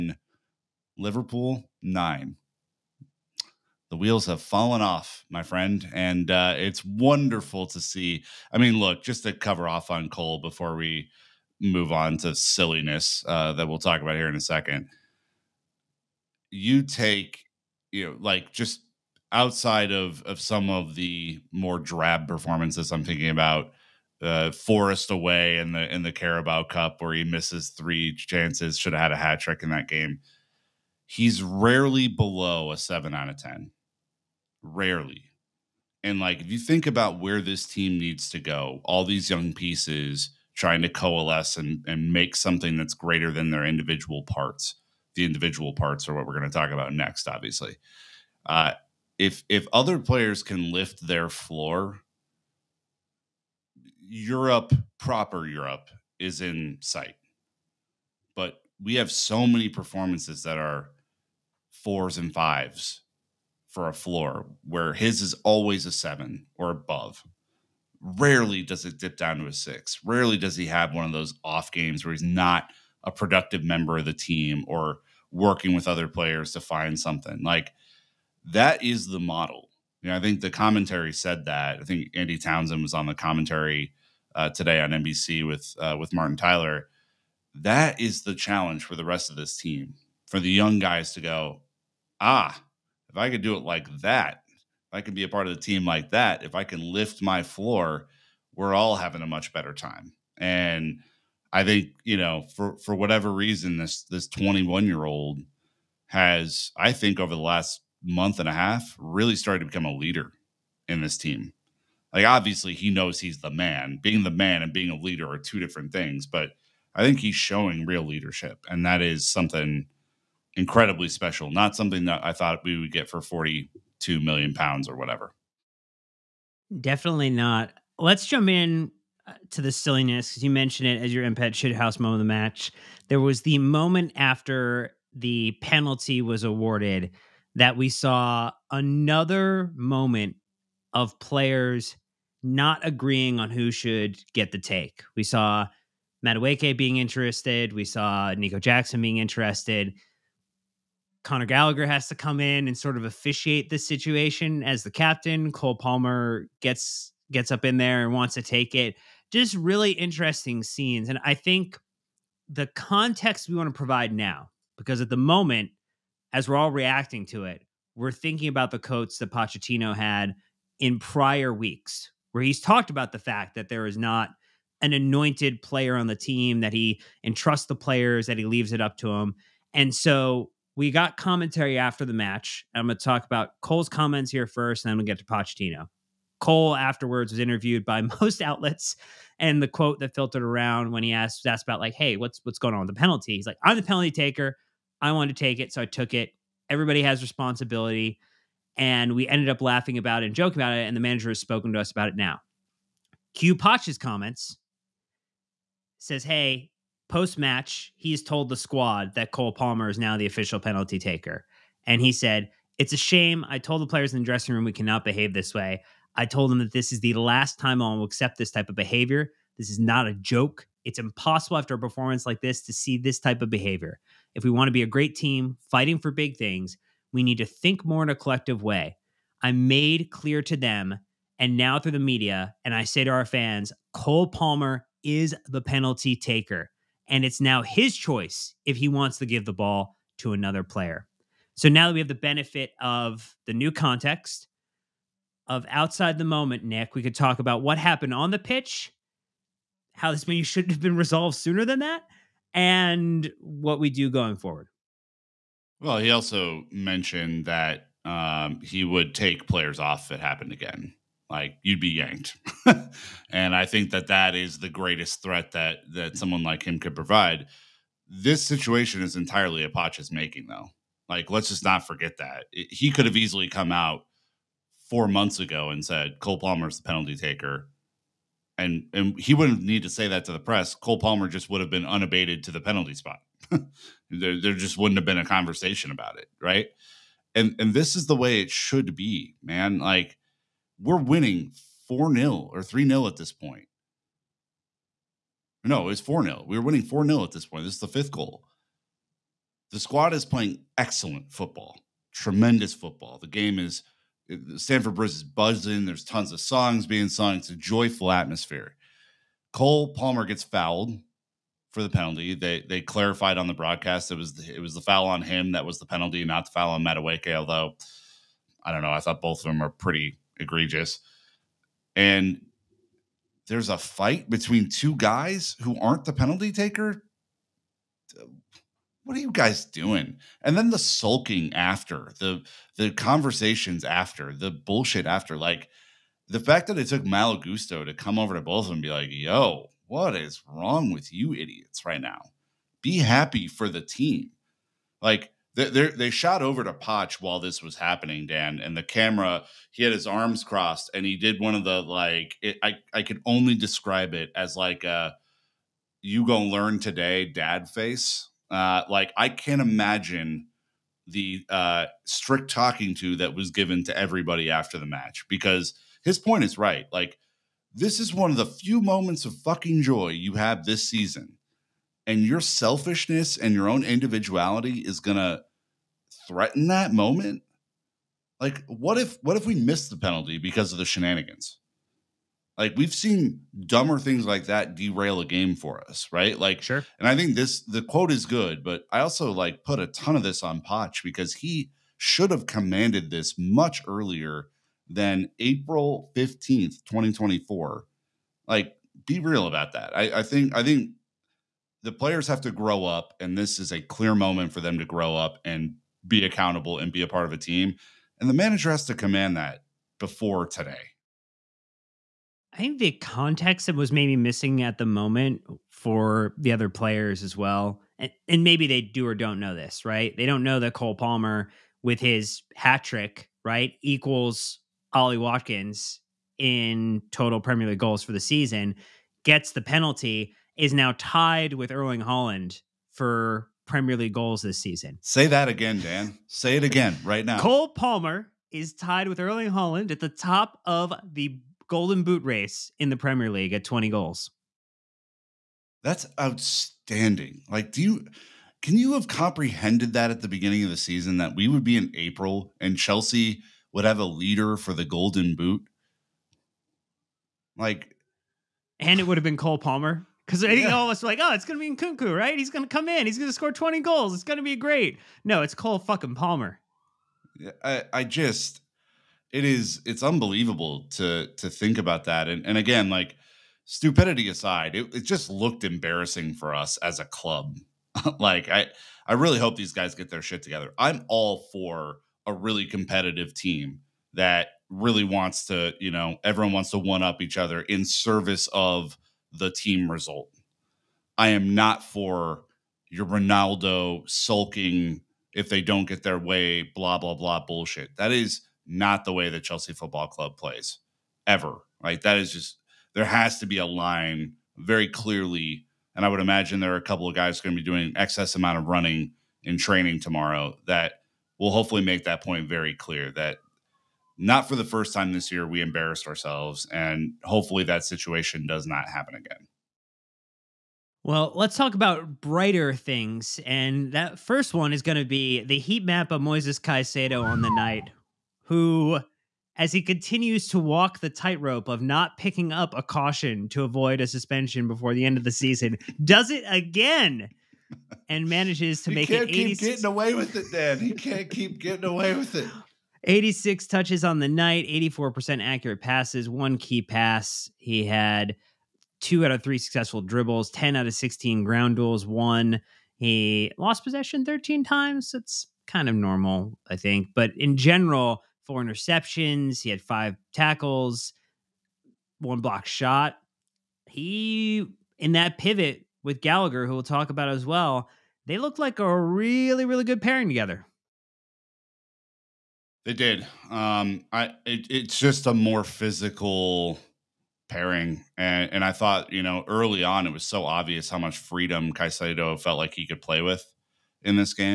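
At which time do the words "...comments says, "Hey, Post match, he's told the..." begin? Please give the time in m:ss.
3:23.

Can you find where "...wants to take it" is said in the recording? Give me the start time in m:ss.
2:38.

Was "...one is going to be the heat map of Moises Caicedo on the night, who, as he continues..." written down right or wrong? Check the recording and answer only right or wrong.
right.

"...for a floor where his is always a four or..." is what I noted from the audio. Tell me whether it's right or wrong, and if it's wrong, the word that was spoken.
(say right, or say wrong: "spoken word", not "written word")
wrong: "seven", not "four".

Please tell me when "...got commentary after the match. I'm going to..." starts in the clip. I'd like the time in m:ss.
3:00.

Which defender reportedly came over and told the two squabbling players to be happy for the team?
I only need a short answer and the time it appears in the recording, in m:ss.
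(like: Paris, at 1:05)
Malo Gusto, at 5:37.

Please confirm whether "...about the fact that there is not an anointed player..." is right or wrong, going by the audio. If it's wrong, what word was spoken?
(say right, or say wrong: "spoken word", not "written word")
right.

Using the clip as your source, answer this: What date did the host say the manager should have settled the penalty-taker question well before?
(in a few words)
April 15th, 2024.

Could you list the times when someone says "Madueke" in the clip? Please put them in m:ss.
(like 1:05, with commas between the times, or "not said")
2:26, 5:16.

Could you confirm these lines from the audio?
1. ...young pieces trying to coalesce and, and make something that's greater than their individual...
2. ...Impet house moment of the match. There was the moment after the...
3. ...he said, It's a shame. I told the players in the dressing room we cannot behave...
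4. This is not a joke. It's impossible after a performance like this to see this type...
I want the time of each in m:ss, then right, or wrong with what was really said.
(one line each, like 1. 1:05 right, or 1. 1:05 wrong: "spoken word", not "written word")
1. 0:39 right
2. 2:11 right
3. 3:31 right
4. 3:39 right.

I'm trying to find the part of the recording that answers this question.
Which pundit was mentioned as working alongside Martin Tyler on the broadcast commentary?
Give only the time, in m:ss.
1:22.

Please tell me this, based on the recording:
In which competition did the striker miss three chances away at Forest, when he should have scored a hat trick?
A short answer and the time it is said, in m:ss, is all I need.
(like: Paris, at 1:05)
Carabao Cup, at 0:26.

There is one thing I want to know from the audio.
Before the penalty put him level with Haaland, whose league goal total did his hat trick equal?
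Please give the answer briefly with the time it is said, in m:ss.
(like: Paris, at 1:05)
Ollie Watkins, at 7:04.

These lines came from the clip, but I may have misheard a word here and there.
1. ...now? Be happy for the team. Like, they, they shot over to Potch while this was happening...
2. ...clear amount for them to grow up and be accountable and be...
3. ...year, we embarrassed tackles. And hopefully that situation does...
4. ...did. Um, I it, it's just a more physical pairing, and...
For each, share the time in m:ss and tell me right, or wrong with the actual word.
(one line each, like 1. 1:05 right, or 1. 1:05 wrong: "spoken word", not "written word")
1. 5:42 right
2. 6:43 wrong: "moment", not "amount"
3. 8:35 wrong: "ourselves", not "tackles"
4. 9:32 right.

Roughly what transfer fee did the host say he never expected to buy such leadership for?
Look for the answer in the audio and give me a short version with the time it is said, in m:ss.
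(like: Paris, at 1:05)
42 million pounds, at 2:03.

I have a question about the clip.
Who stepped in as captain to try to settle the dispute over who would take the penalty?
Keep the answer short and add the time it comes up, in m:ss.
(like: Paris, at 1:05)
Connor Gallagher, at 2:31.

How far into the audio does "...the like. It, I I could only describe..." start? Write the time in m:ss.
5:51.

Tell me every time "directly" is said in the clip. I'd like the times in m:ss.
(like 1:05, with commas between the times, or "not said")
not said.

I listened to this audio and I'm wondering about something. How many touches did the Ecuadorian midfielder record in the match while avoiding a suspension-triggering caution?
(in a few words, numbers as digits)
86.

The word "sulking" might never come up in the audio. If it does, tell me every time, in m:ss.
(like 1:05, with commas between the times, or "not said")
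5:30, 8:14.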